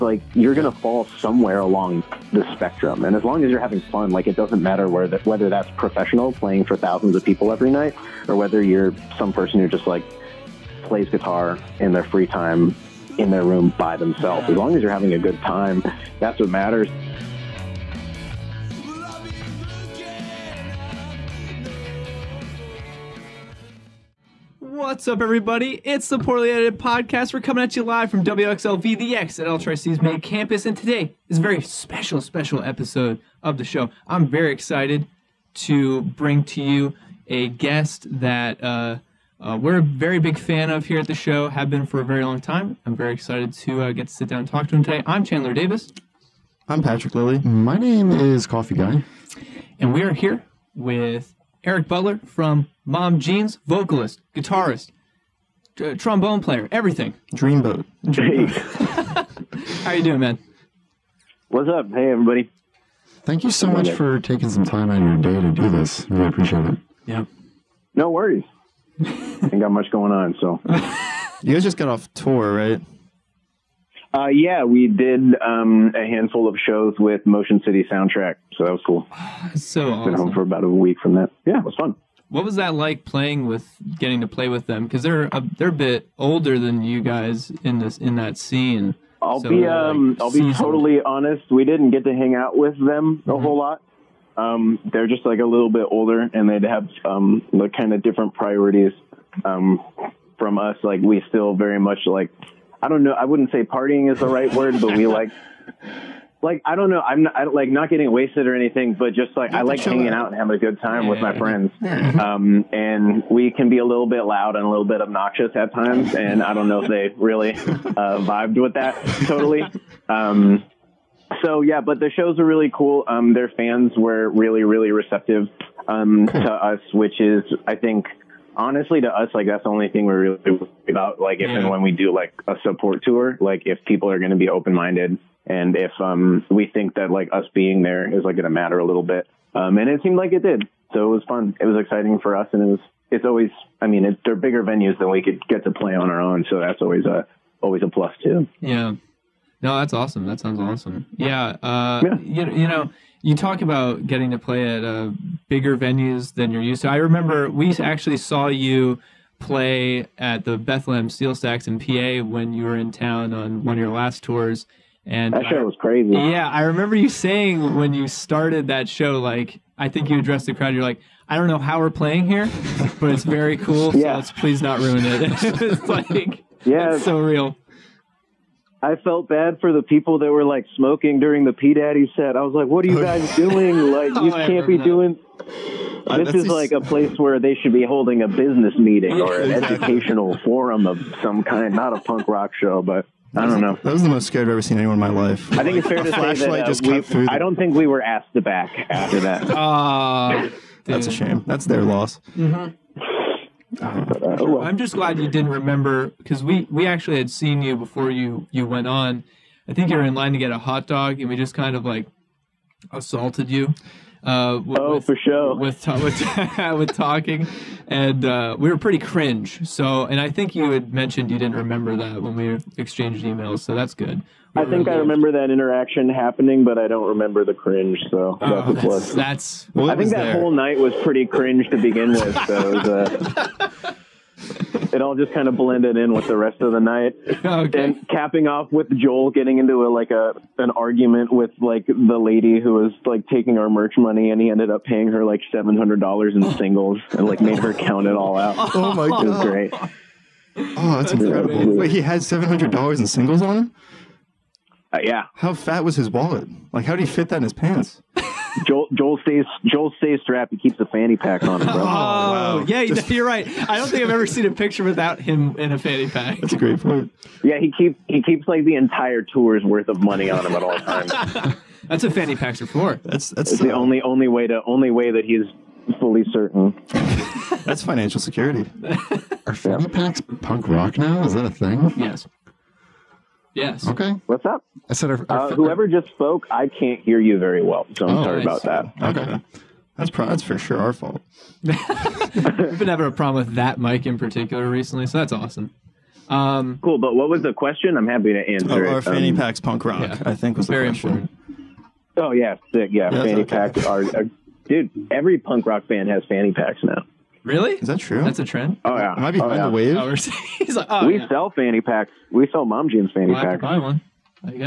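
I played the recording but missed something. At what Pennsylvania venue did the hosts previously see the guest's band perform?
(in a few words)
Bethlehem Steel Stacks.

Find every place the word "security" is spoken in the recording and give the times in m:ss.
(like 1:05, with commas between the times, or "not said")
4:38.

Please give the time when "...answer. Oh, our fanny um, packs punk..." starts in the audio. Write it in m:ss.
4:58.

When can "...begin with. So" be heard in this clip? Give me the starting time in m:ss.
3:51.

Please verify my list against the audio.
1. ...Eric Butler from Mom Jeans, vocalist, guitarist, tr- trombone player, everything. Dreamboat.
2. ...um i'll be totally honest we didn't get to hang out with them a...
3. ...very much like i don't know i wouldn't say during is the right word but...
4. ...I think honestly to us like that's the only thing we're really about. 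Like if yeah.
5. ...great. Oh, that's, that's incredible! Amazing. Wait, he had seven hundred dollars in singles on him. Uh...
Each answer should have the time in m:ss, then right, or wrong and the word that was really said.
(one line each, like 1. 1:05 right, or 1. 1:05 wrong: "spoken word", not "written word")
1. 0:51 right
2. 1:29 right
3. 1:41 wrong: "partying", not "during"
4. 2:07 right
5. 4:09 right.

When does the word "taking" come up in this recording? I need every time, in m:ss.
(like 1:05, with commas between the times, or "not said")
1:04, 4:03.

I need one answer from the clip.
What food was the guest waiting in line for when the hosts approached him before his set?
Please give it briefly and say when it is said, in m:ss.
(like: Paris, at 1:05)
hot dog, at 3:30.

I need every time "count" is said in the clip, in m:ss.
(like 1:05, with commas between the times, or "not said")
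4:07.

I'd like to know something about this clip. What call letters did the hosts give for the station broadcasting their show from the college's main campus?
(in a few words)
WXLV.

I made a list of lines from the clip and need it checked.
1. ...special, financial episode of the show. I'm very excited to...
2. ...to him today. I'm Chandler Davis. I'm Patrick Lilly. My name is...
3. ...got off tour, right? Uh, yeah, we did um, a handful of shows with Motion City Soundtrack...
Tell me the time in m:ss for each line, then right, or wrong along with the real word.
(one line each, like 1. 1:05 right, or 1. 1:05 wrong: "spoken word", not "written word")
1. 0:31 wrong: "special", not "financial"
2. 0:44 right
3. 1:11 right.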